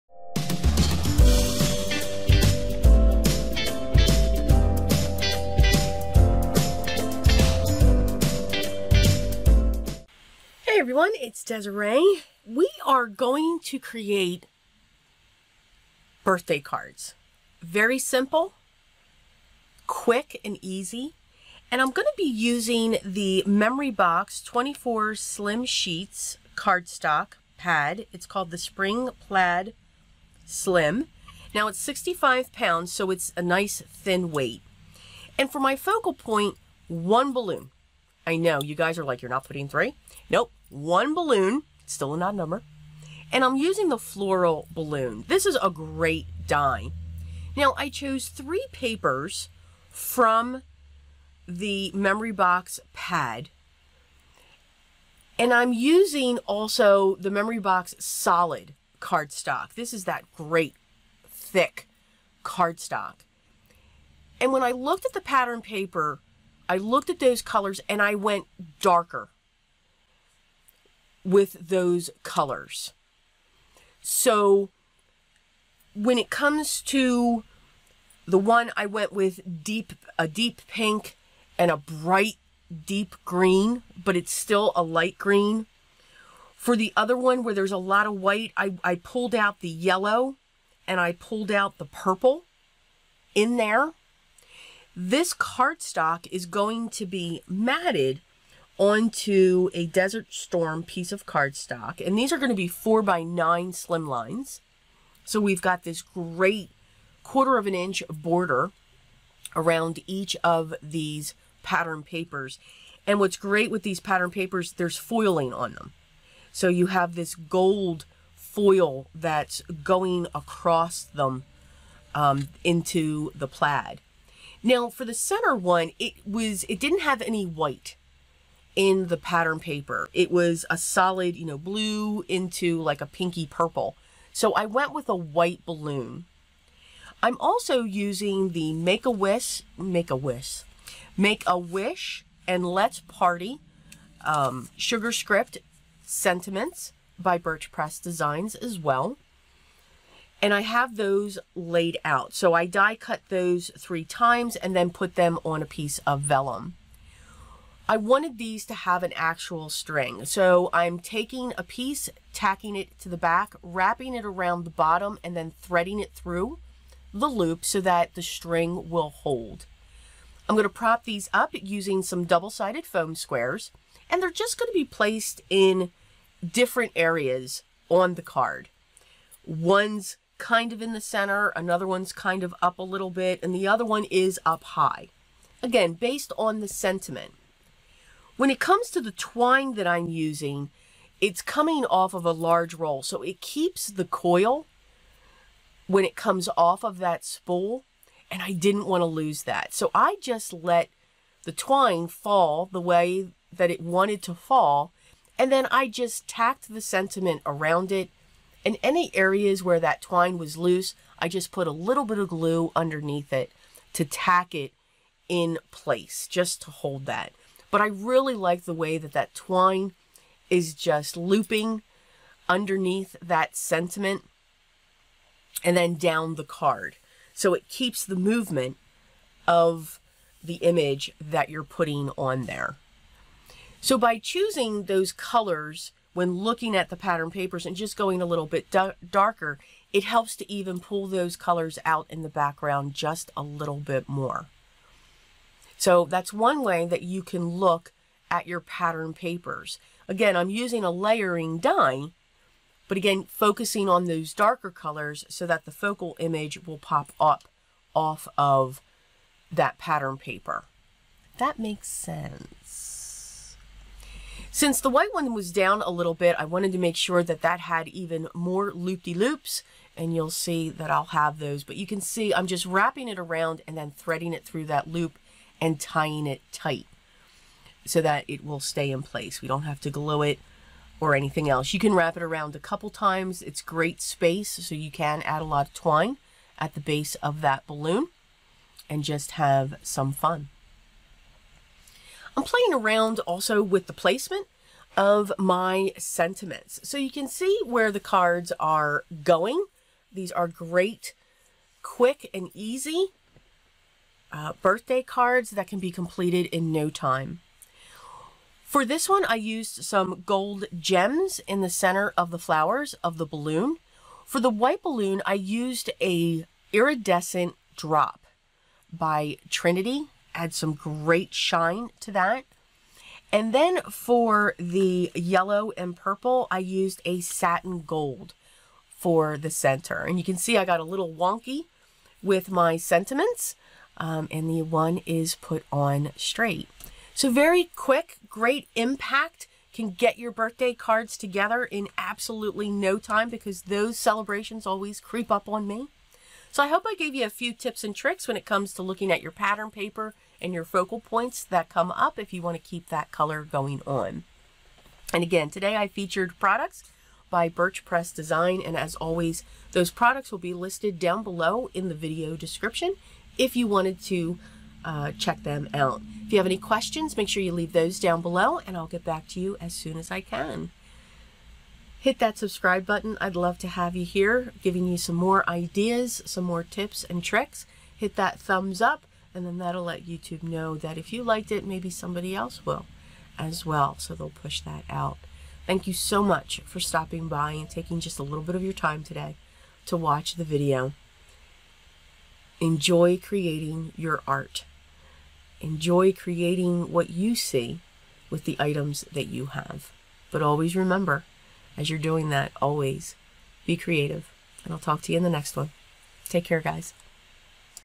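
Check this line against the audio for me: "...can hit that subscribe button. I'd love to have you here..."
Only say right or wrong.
right.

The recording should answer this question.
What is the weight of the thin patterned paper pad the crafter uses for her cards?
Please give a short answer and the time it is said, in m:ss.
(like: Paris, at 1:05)
65 pounds, at 0:31.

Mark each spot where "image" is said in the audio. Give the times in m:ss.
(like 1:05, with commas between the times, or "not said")
3:50, 4:16.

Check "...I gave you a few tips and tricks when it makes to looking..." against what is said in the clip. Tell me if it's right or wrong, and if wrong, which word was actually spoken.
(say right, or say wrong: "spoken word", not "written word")
wrong: "comes", not "makes".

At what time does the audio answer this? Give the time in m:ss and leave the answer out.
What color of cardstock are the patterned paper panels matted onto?
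1:39.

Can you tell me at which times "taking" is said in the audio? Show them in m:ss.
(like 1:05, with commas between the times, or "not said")
2:40, 6:27.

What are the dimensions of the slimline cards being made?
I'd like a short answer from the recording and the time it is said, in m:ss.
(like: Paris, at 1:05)
4 by 9, at 1:42.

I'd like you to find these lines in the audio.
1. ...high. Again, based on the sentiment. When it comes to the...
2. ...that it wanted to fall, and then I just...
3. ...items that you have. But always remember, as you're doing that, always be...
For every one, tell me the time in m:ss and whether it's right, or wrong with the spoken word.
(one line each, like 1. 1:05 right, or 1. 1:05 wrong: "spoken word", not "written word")
1. 3:04 right
2. 3:23 right
3. 6:38 right.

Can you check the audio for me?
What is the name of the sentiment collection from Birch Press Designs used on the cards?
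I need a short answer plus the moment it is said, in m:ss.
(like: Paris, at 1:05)
Sugar Script Sentiments, at 2:24.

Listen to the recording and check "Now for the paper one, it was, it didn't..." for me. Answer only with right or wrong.
wrong.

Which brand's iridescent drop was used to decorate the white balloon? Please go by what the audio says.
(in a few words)
Trinity.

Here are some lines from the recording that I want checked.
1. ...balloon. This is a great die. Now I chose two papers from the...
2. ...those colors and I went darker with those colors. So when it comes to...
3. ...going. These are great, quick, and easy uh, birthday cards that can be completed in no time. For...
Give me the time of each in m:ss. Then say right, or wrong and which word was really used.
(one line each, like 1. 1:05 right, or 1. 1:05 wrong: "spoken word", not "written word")
1. 0:44 wrong: "three", not "two"
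2. 1:07 right
3. 4:59 right.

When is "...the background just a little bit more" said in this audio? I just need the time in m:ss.
4:02.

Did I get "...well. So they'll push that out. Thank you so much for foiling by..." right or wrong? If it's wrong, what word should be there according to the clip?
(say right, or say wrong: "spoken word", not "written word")
wrong: "stopping", not "foiling".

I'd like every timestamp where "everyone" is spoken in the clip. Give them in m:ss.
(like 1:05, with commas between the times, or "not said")
0:10.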